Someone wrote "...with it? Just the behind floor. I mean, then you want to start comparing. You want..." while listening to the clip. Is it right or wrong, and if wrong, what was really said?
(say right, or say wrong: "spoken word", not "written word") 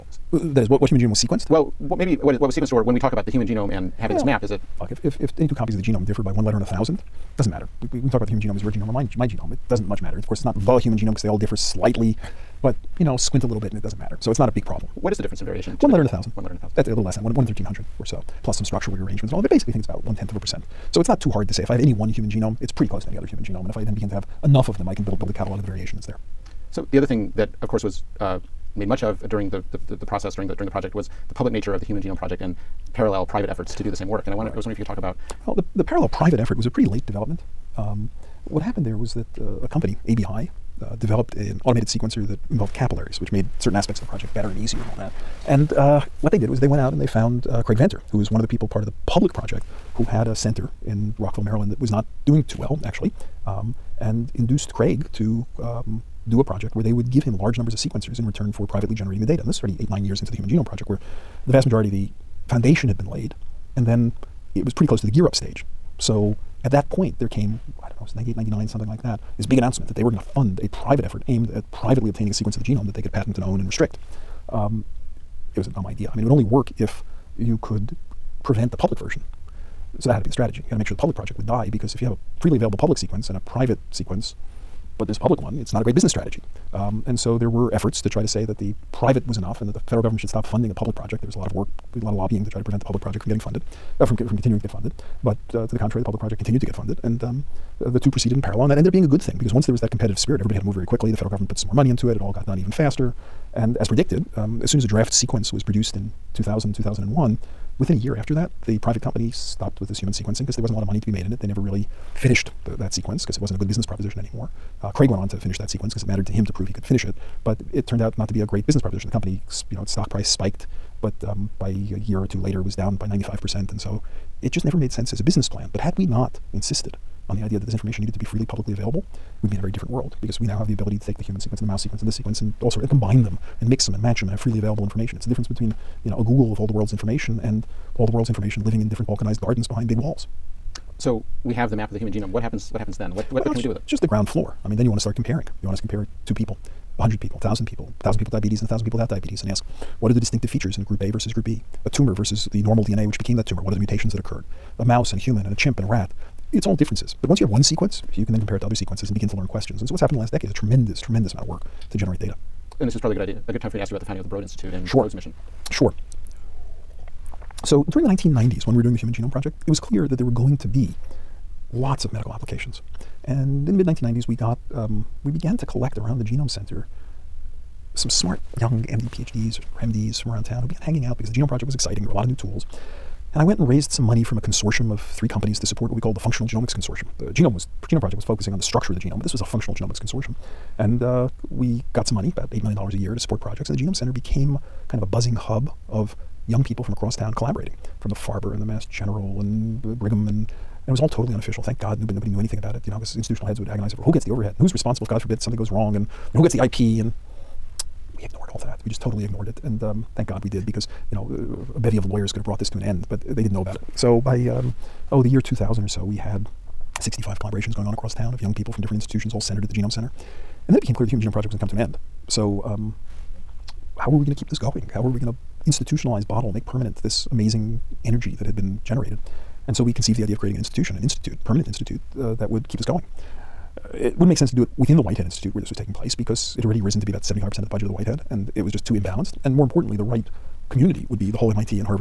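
wrong: "ground", not "behind".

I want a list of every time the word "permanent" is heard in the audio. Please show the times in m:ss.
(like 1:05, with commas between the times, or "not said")
3:46, 3:51.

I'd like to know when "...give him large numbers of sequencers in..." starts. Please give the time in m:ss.
0:57.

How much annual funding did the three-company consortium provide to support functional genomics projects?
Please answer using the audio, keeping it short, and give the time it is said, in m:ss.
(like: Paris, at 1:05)
$8 million, at 3:12.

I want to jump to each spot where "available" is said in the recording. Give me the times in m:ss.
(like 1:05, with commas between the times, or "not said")
1:22, 2:08, 2:14.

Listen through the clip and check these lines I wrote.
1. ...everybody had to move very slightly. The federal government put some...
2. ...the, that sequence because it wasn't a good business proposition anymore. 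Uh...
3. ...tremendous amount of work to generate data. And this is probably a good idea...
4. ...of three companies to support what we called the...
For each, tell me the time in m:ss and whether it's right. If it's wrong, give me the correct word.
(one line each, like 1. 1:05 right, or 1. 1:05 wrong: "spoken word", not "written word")
1. 1:40 wrong: "quickly", not "slightly"
2. 1:52 right
3. 2:40 right
4. 3:04 right.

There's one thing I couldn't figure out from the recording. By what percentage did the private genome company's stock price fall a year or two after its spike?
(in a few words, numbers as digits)
95%.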